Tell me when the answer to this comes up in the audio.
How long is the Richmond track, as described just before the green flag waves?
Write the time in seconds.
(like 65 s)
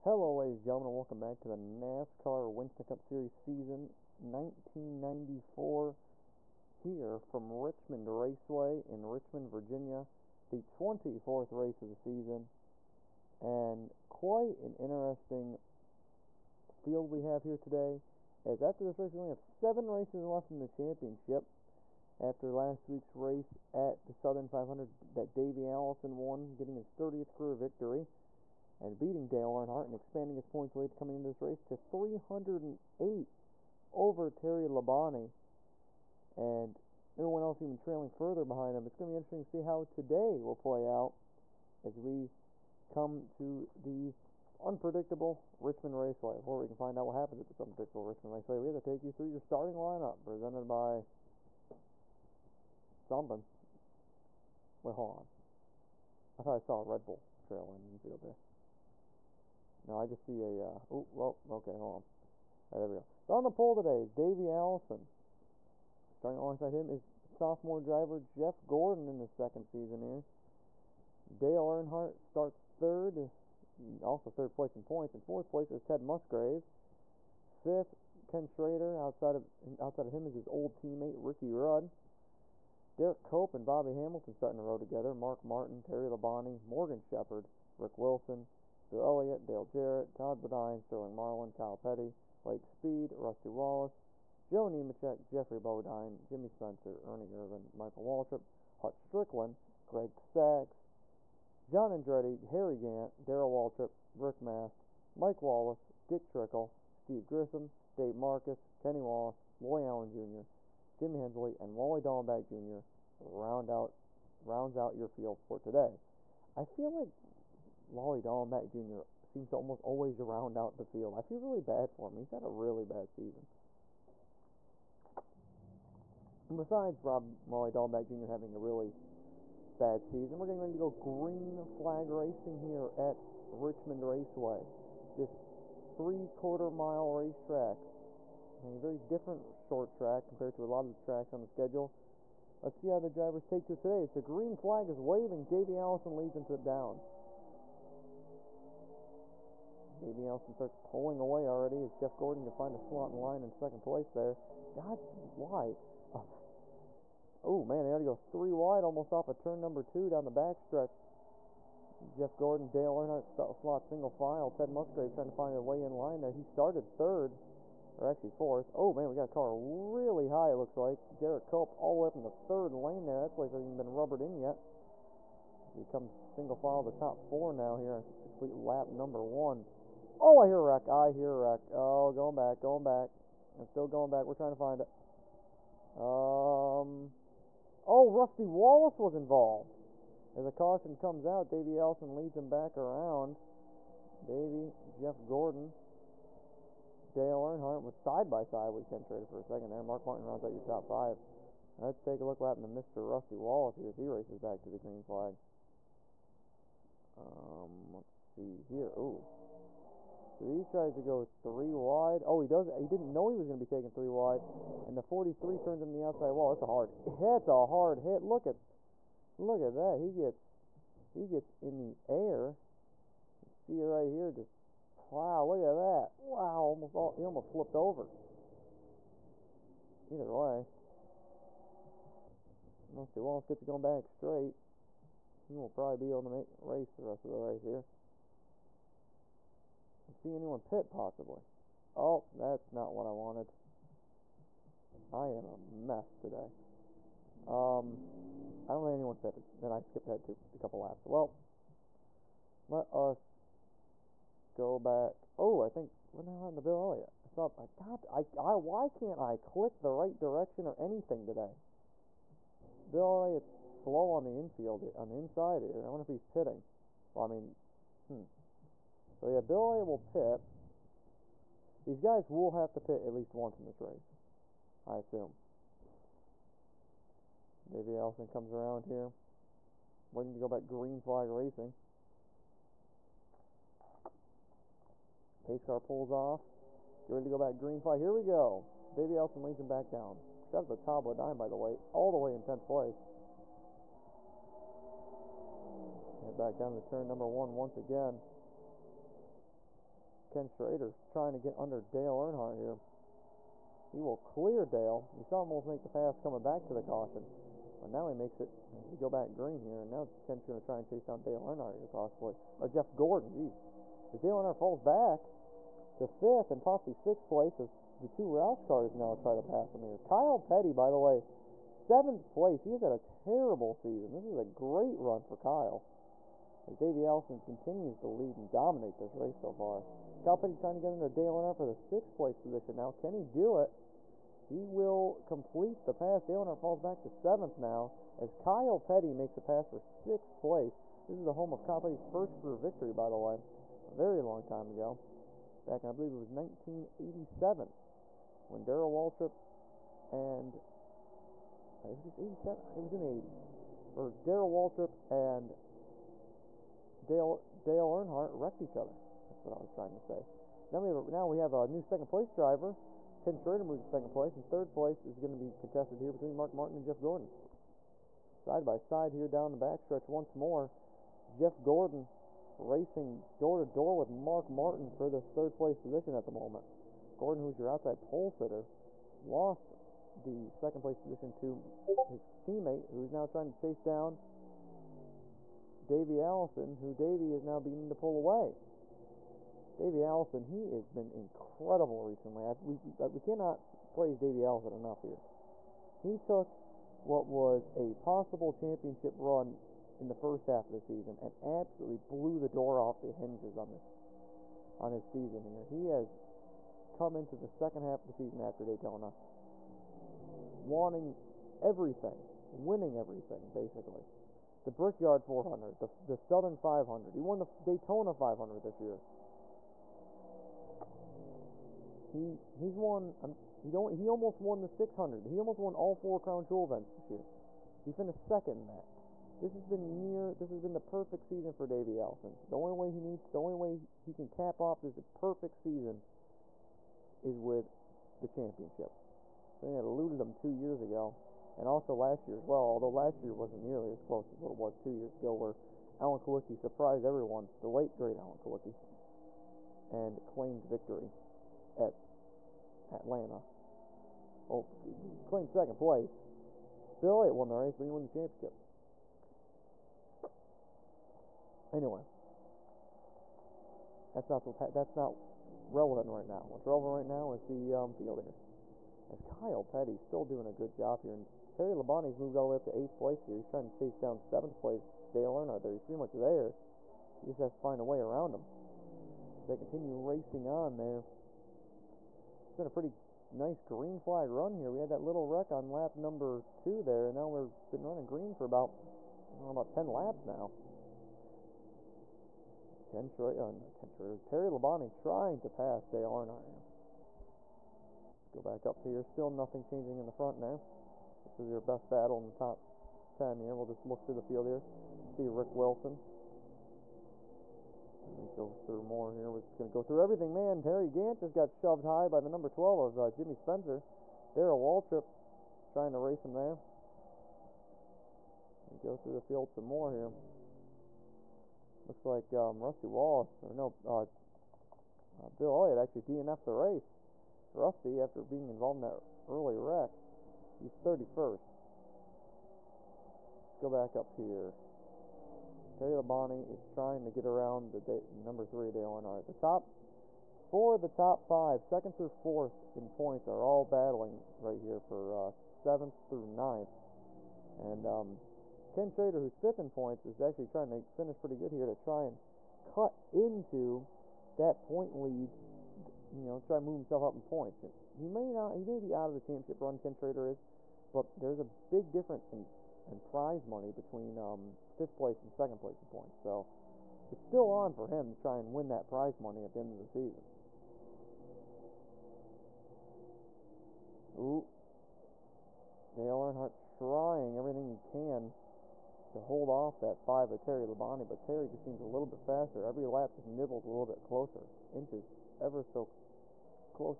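135 s.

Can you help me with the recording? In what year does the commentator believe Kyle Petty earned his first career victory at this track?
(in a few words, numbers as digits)
1987.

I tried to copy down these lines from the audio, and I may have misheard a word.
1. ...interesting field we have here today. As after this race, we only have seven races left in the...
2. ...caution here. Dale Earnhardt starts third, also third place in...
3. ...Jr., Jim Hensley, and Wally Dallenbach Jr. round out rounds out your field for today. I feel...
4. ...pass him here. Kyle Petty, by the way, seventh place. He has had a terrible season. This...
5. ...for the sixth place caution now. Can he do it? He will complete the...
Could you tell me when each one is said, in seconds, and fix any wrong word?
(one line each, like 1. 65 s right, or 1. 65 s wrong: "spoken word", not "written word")
1. 14 s right
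2. 69 s wrong: "season", not "caution"
3. 110 s right
4. 319 s right
5. 331 s wrong: "position", not "caution".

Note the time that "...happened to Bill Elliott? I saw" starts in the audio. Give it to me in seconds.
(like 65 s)
256 s.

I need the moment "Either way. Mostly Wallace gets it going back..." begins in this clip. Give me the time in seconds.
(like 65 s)
230 s.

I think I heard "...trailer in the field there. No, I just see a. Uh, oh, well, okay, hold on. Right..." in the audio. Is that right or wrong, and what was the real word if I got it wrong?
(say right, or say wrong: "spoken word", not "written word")
right.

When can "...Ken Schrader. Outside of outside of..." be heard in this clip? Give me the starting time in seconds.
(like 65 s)
78 s.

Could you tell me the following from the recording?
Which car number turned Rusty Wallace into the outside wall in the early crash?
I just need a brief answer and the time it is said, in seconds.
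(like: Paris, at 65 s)
43, at 215 s.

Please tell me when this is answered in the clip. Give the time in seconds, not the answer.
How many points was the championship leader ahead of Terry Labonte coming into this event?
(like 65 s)
31 s.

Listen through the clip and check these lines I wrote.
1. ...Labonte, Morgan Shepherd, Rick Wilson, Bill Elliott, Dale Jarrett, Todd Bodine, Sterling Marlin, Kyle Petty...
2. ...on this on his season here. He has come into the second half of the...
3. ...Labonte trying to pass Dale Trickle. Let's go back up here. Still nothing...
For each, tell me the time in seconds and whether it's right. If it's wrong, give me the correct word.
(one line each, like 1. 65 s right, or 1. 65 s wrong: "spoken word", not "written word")
1. 86 s right
2. 403 s right
3. 494 s wrong: "Earnhardt", not "Trickle".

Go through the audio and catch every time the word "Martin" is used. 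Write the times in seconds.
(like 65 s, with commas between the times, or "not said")
85 s, 200 s, 366 s, 374 s.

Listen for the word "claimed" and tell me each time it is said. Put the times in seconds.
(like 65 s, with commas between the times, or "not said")
450 s, 455 s.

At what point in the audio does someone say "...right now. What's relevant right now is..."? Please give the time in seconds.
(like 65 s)
466 s.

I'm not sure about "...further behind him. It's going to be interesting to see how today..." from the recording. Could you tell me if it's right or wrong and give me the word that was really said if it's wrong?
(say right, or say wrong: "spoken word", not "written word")
right.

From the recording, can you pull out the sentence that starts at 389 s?
Davy Allison, he has been incredible recently.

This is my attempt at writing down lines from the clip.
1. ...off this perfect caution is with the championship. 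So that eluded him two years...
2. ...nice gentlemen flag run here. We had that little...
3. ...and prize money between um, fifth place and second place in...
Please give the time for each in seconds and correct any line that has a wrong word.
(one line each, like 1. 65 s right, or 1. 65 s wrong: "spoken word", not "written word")
1. 434 s wrong: "season", not "caution"
2. 483 s wrong: "green", not "gentlemen"
3. 562 s right.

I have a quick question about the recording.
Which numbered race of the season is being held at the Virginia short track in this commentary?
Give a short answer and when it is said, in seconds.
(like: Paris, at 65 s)
24th, at 10 s.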